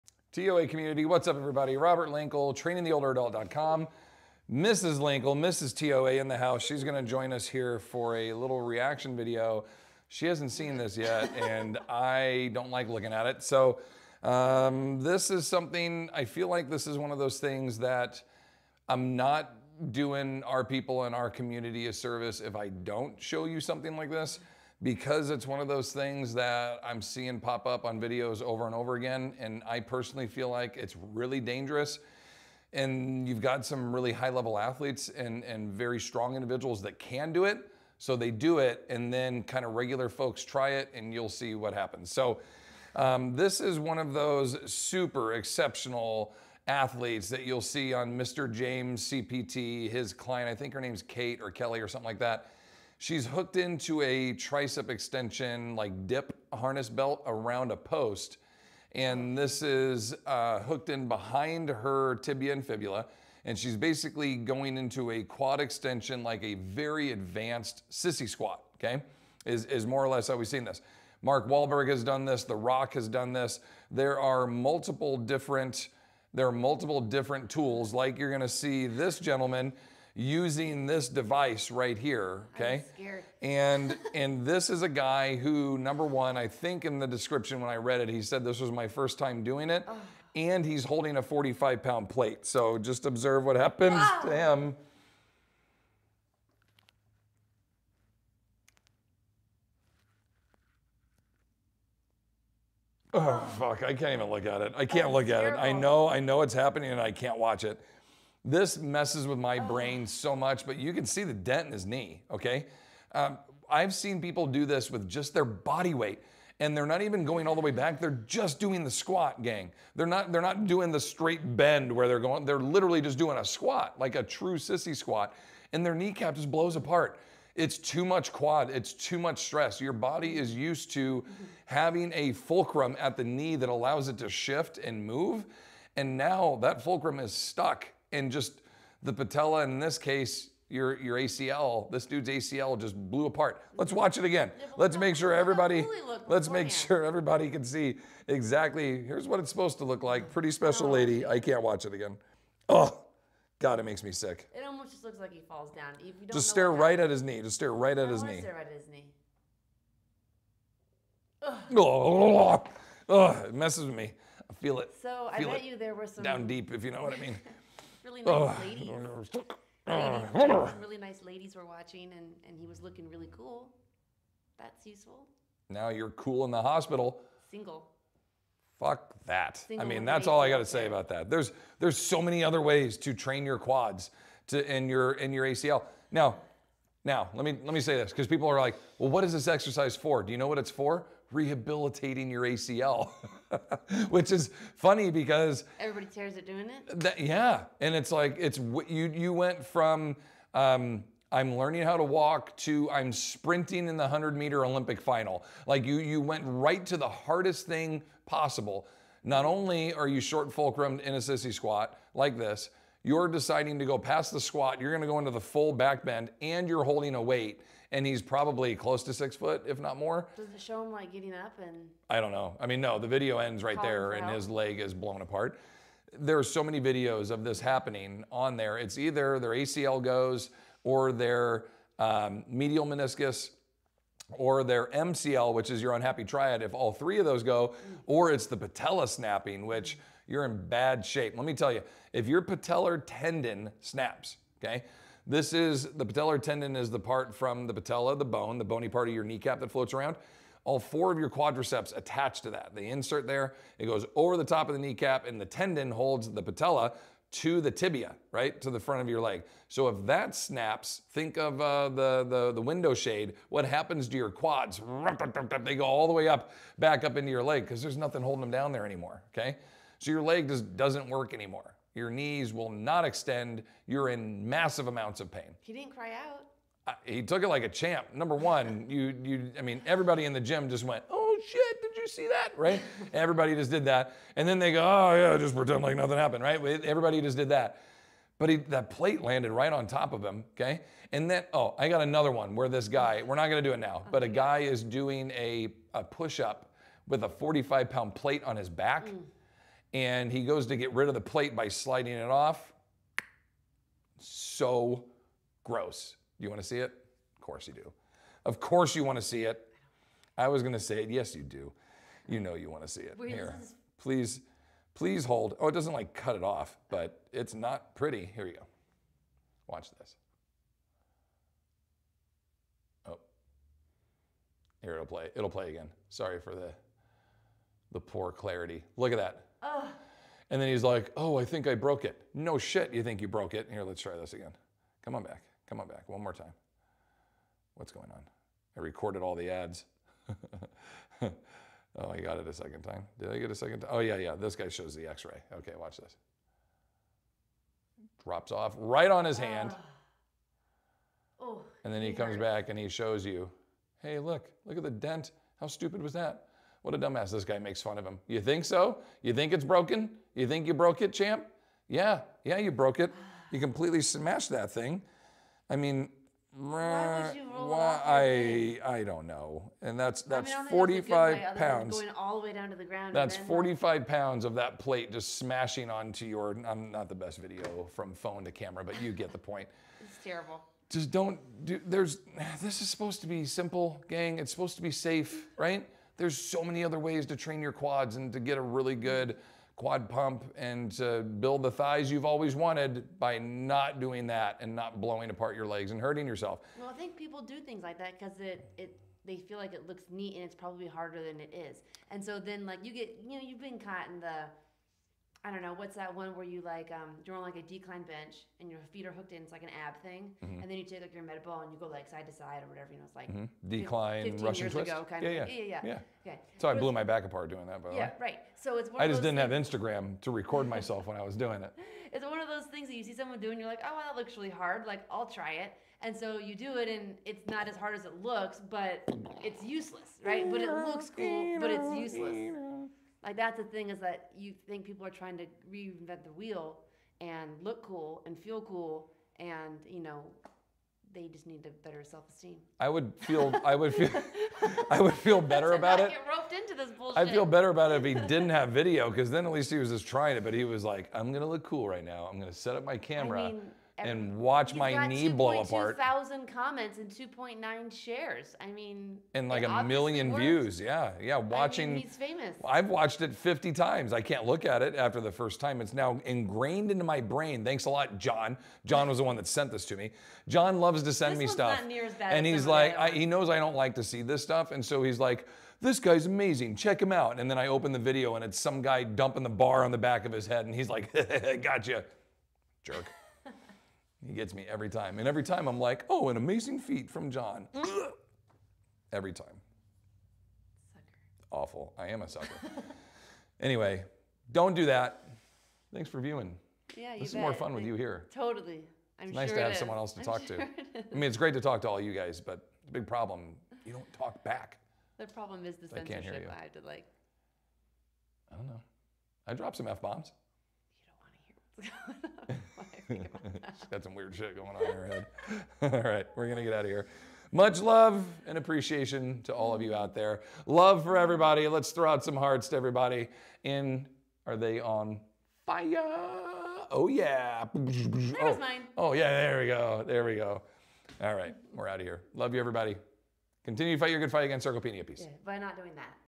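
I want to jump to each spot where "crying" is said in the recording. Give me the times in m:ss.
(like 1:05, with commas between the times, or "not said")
not said.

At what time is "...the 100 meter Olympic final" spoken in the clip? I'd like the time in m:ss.
3:23.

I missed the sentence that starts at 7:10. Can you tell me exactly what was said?
But it looks cool, but it's useless.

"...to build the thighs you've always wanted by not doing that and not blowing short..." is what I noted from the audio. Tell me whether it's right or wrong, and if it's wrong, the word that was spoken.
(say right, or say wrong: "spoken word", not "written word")
wrong: "apart", not "short".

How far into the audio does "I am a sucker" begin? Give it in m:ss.
8:11.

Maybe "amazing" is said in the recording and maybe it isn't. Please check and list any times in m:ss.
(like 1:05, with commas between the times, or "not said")
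7:56, 8:06.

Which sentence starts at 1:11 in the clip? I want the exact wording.
Mark Wahlberg has done this, The Rock has done this.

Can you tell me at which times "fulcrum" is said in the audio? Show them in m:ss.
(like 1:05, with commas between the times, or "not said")
2:12, 2:16, 3:30.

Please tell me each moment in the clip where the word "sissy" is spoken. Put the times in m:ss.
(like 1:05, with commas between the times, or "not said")
1:07, 2:04, 3:31.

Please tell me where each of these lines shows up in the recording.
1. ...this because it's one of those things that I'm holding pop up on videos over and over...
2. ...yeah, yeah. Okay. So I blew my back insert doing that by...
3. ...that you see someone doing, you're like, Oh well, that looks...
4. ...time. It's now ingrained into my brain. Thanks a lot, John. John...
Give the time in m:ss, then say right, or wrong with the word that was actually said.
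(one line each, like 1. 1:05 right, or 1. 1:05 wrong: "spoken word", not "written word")
1. 0:24 wrong: "seeing", not "holding"
2. 6:55 wrong: "apart", not "insert"
3. 7:02 right
4. 7:45 right.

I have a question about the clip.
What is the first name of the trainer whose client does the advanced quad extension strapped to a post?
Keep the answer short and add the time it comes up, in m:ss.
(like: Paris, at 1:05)
James, at 0:48.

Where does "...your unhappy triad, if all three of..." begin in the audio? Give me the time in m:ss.
3:55.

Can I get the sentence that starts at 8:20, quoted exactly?
I mean, it's great to talk to all you guys, but the big problem, you don't talk back.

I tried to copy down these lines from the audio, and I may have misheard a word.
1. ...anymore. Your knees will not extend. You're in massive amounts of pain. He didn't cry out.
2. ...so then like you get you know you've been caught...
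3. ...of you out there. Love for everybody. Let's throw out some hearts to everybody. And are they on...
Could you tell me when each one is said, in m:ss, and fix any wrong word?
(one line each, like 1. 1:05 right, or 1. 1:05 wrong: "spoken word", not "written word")
1. 4:31 right
2. 6:42 right
3. 8:39 right.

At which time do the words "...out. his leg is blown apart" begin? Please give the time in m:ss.
3:44.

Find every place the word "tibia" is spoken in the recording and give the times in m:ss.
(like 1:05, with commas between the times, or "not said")
1:02, 4:17.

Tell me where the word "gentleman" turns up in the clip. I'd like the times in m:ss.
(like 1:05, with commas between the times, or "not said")
1:19.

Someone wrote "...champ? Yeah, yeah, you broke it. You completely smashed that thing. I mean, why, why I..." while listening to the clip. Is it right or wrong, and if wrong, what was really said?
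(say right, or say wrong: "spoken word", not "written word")
right.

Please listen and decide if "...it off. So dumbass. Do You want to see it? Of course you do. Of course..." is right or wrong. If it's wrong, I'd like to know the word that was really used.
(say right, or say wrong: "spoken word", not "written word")
wrong: "gross", not "dumbass".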